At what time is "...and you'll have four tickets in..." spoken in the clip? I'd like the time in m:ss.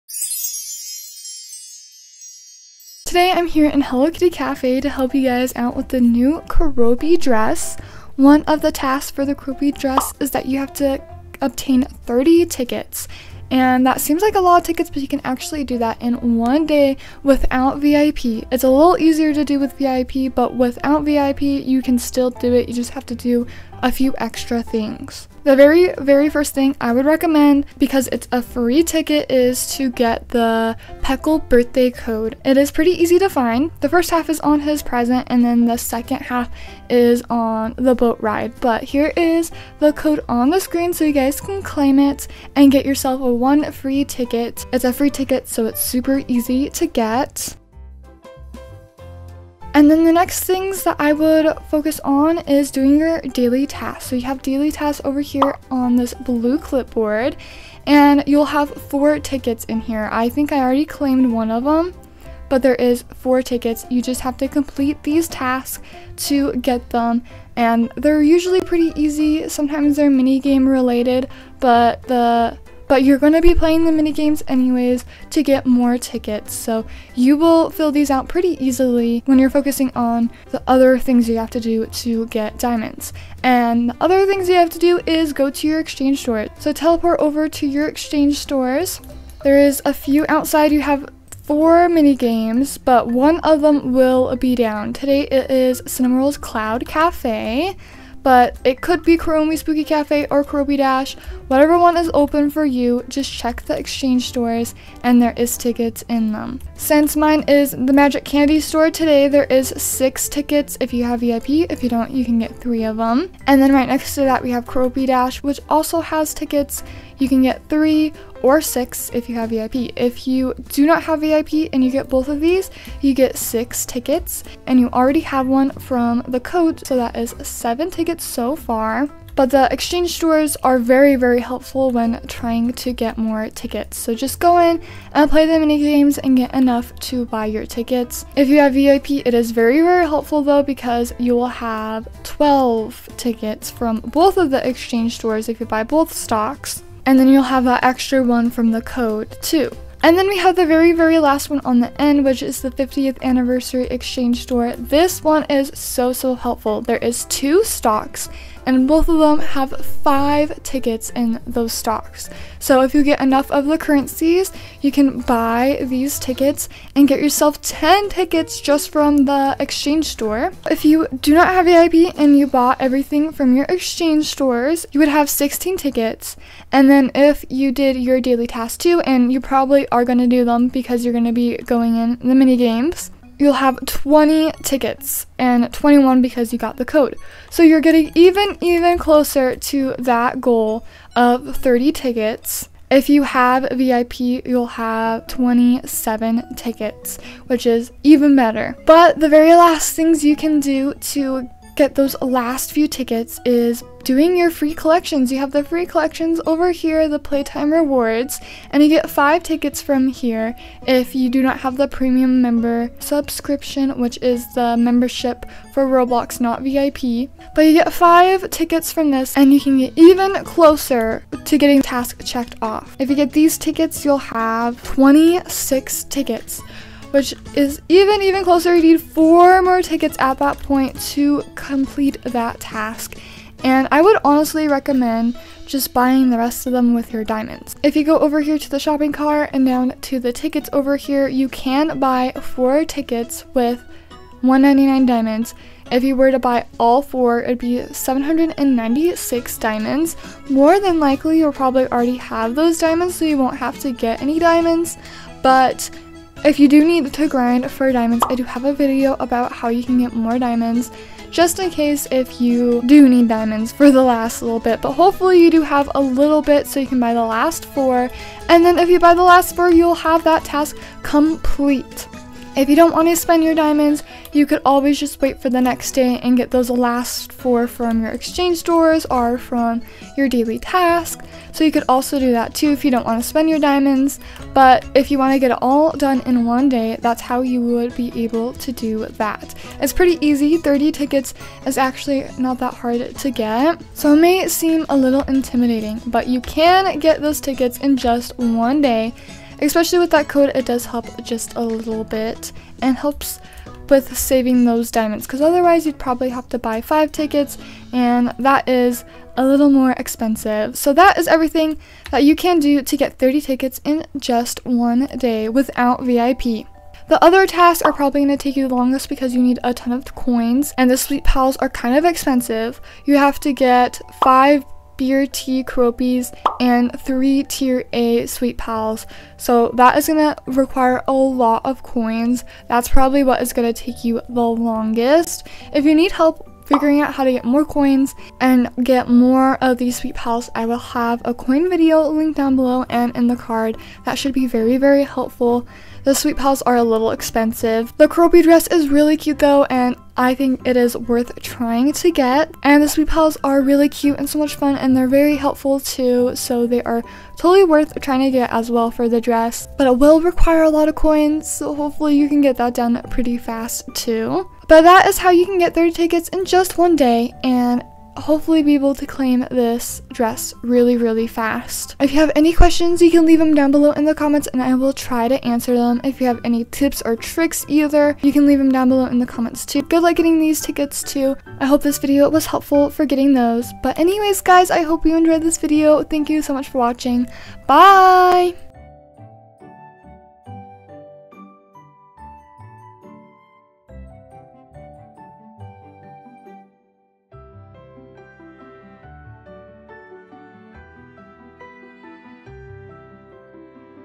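0:57.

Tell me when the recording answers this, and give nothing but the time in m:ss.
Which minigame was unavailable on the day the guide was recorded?
1:35.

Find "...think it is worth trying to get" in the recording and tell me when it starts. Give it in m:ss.
5:50.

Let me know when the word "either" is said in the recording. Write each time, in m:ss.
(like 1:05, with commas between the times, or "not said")
6:17.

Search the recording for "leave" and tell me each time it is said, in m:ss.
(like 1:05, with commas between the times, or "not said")
6:13, 6:18.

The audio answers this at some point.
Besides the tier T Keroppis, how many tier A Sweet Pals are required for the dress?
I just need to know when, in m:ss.
5:27.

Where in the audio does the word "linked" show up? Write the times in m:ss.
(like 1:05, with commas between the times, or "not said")
5:42.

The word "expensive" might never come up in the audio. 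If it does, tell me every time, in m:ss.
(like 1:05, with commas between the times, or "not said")
5:09, 5:22, 5:47.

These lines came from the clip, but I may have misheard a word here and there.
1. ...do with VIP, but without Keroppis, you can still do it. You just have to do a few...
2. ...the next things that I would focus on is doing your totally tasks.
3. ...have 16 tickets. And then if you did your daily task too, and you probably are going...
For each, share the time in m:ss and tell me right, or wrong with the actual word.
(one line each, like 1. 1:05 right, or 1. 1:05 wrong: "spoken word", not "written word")
1. 0:19 wrong: "VIP", not "Keroppis"
2. 0:50 wrong: "daily", not "totally"
3. 2:55 right.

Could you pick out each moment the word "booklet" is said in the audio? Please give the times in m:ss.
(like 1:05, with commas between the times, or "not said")
not said.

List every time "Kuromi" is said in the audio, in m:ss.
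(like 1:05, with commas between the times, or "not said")
1:39.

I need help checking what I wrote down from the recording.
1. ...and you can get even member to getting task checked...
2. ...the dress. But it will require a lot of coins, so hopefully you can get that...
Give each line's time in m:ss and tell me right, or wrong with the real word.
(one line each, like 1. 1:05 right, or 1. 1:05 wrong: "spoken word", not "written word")
1. 3:39 wrong: "closer", not "member"
2. 5:59 right.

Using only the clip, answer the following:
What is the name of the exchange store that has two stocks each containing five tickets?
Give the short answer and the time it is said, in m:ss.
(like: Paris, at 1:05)
50th anniversary exchange store, at 2:32.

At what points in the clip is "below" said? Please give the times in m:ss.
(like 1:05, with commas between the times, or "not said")
5:42, 6:13, 6:18.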